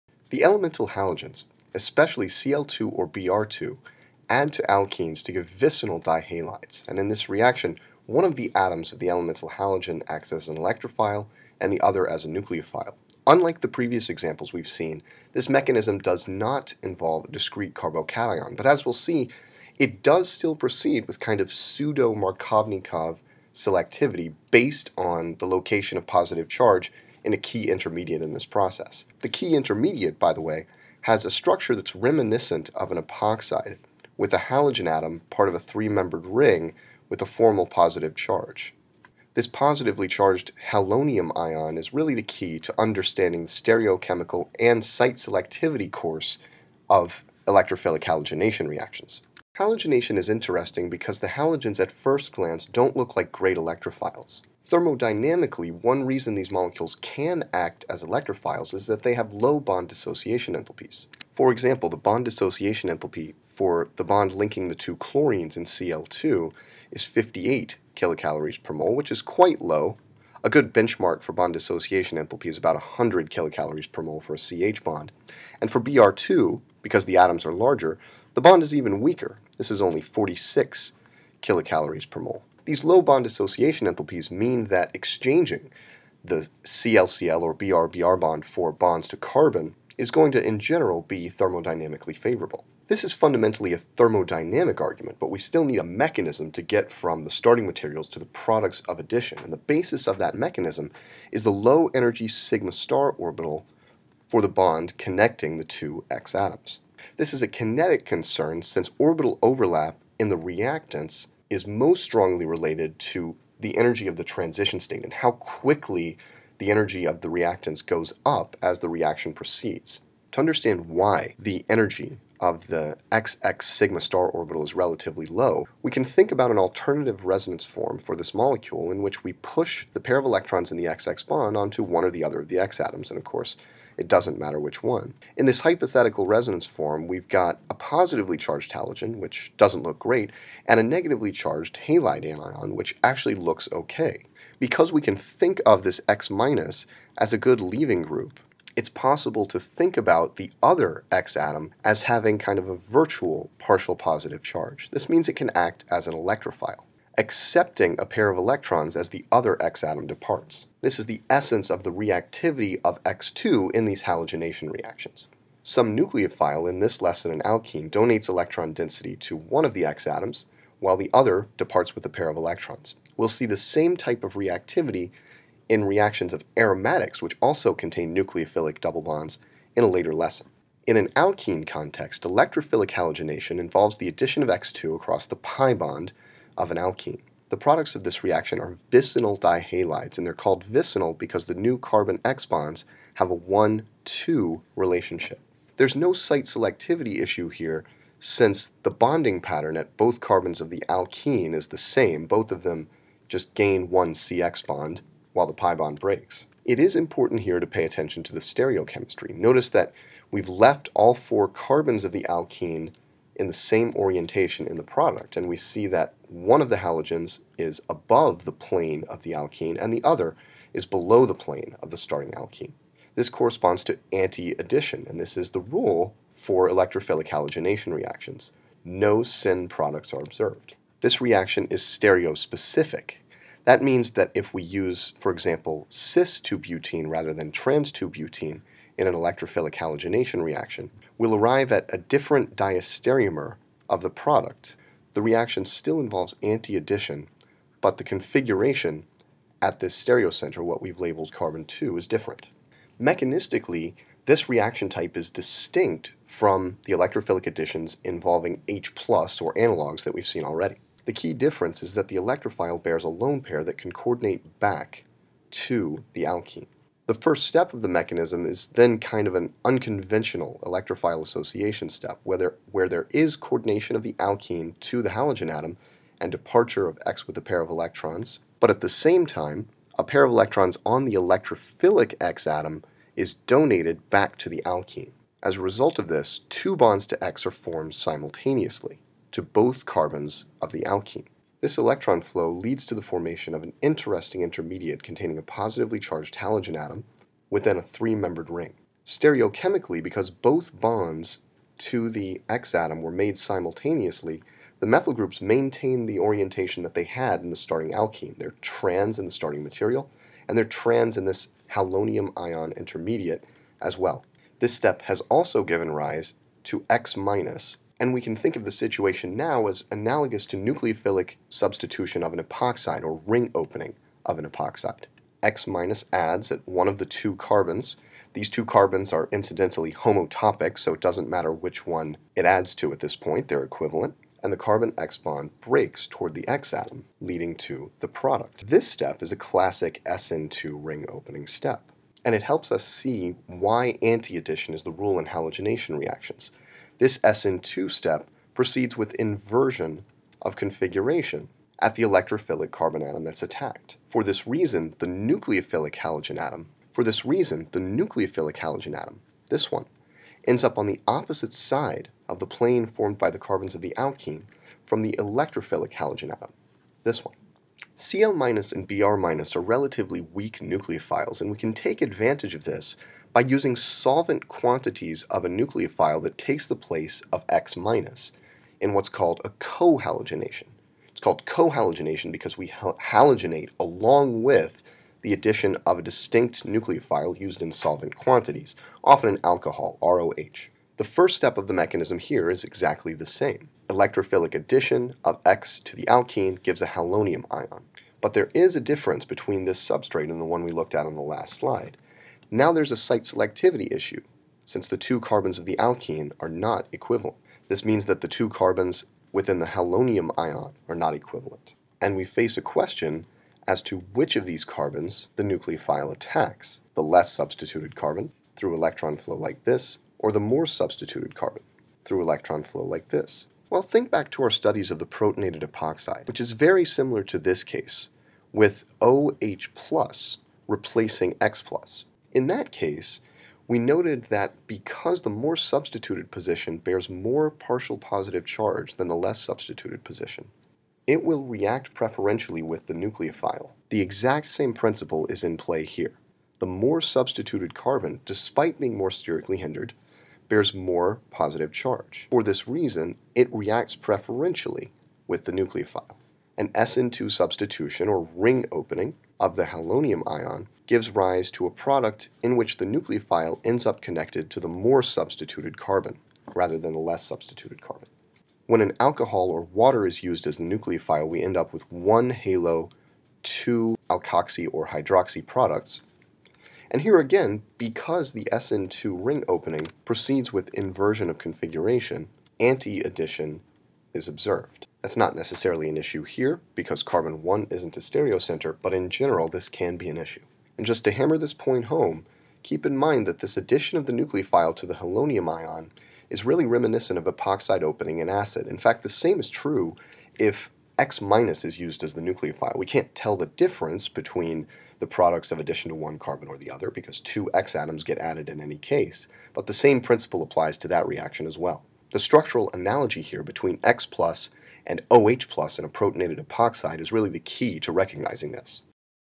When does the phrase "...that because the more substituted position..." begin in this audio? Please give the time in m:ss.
7:14.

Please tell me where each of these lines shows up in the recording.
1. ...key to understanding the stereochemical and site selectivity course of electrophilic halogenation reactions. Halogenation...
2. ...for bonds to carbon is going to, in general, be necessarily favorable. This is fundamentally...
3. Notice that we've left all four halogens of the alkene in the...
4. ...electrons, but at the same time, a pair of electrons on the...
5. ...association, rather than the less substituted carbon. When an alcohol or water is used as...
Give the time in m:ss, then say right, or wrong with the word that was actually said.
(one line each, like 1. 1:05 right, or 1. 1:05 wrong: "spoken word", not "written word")
1. 0:42 right
2. 1:28 wrong: "thermodynamically", not "necessarily"
3. 3:29 wrong: "carbons", not "halogens"
4. 4:37 right
5. 7:45 wrong: "carbon", not "association".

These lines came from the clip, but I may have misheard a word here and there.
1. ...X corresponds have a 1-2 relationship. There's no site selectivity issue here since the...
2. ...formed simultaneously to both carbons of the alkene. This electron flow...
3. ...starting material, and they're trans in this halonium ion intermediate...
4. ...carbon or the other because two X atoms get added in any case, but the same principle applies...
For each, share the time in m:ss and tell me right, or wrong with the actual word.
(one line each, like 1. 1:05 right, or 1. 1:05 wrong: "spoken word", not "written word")
1. 3:12 wrong: "bonds", not "corresponds"
2. 4:47 right
3. 5:09 right
4. 8:26 right.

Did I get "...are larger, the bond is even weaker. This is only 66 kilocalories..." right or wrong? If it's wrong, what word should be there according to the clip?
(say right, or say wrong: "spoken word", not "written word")
wrong: "46", not "66".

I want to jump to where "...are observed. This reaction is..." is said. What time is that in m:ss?
3:50.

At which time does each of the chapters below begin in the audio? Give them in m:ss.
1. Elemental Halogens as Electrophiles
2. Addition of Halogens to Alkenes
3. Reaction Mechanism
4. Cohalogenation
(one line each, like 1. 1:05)
1. 0:49
2. 3:00
3. 4:12
4. 6:07.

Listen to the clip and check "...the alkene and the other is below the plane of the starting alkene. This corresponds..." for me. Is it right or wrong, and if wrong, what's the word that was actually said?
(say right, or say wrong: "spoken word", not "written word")
right.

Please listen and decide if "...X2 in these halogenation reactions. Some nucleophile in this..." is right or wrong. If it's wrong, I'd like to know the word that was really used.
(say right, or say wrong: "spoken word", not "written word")
right.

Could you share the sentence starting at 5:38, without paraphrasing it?
This step is a classic SN2 ring opening step, and it helps us see why anti-addition is the rule in halogenation reactions.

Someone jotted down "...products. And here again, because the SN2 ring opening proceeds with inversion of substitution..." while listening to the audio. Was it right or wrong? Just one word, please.
wrong.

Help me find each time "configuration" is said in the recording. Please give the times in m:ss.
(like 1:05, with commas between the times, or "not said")
4:08, 5:50, 8:01.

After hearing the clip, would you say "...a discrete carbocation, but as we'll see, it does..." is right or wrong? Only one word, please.
right.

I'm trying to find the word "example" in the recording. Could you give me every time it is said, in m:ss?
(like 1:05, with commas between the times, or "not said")
0:14, 1:01, 3:55.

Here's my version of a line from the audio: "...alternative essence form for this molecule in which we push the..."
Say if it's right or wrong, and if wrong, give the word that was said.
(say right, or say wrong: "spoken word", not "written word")
wrong: "resonance", not "essence".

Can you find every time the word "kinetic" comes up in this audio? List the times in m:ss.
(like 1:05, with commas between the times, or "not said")
1:47.